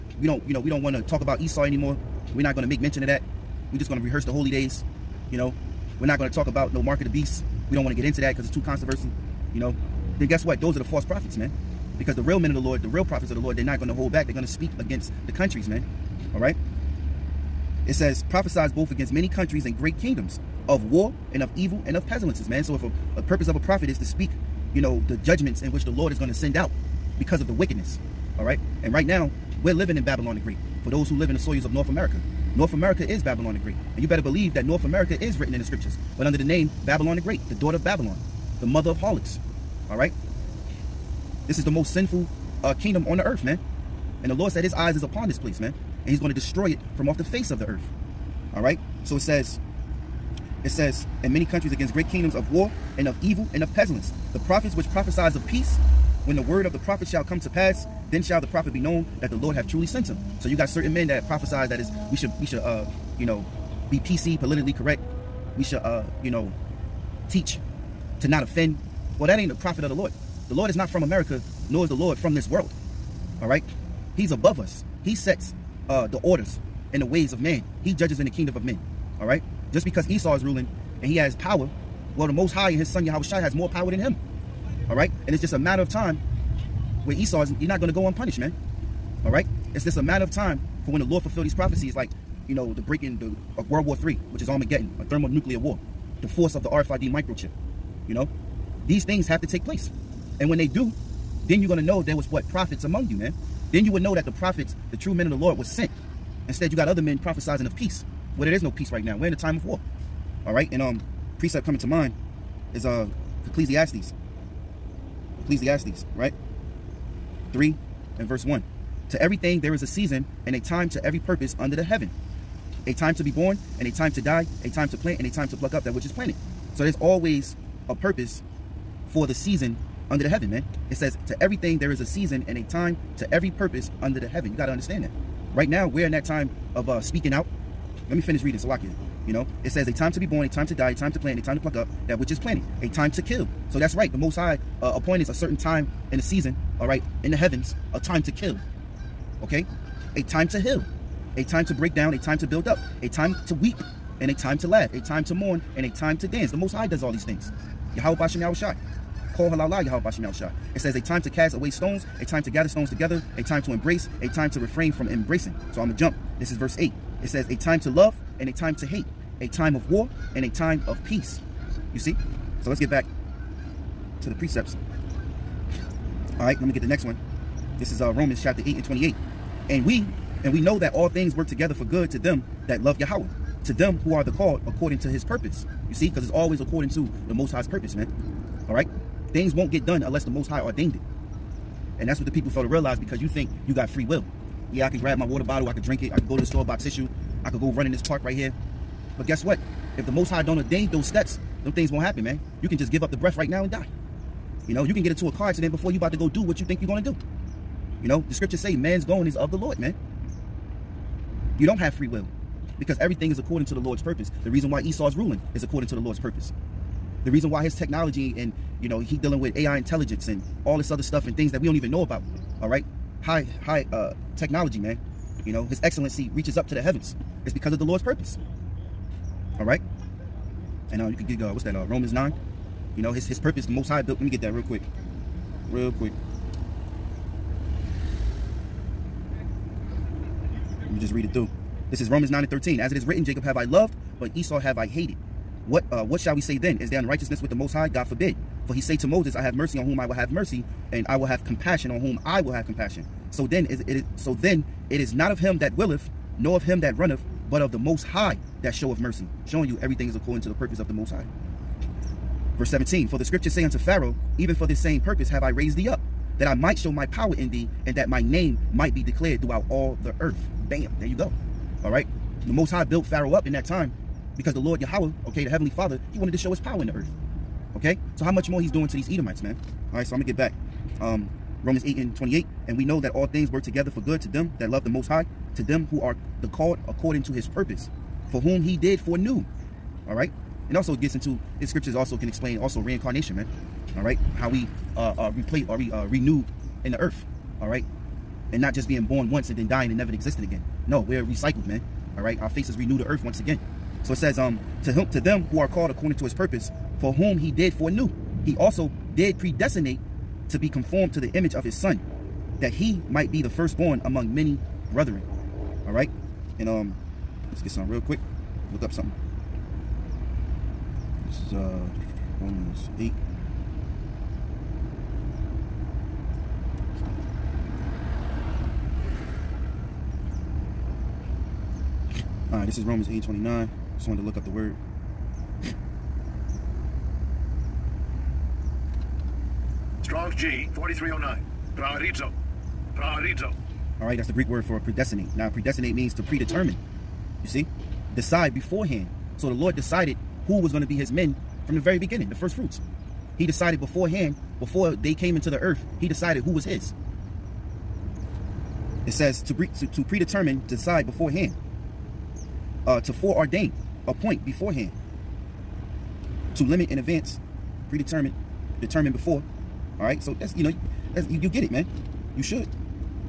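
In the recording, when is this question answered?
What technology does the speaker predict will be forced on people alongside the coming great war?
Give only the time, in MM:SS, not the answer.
01:36.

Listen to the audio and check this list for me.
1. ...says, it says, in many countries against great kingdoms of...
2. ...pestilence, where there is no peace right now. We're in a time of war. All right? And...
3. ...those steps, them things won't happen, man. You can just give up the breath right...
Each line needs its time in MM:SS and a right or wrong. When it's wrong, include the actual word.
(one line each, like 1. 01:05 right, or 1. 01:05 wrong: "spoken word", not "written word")
1. 00:49 right
2. 01:47 wrong: "peace", not "pestilence"
3. 03:20 right.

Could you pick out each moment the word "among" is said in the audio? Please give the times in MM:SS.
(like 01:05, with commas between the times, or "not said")
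01:42, 05:14.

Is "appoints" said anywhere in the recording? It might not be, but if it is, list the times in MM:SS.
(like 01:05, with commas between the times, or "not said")
02:24, 06:04.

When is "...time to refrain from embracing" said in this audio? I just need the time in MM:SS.
02:44.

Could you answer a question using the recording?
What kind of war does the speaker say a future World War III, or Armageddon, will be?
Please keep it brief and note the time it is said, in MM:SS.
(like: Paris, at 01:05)
A thermonuclear war, at 01:35.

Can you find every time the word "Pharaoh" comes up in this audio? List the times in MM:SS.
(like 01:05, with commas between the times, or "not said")
04:23, 04:33.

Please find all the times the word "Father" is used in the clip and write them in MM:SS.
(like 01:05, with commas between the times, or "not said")
04:35.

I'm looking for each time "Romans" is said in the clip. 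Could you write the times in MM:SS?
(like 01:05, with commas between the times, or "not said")
02:58, 03:51, 04:02, 04:41, 05:22, 05:32.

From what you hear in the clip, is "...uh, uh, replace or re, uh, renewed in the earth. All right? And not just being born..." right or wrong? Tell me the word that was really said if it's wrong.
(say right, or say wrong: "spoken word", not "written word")
right.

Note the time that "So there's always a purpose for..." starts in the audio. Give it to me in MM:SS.
02:06.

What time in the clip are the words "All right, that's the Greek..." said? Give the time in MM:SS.
05:44.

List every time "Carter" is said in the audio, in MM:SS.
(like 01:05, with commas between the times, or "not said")
not said.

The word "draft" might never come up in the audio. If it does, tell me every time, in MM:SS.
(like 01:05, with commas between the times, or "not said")
not said.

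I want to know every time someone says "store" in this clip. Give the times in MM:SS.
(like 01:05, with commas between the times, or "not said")
03:16.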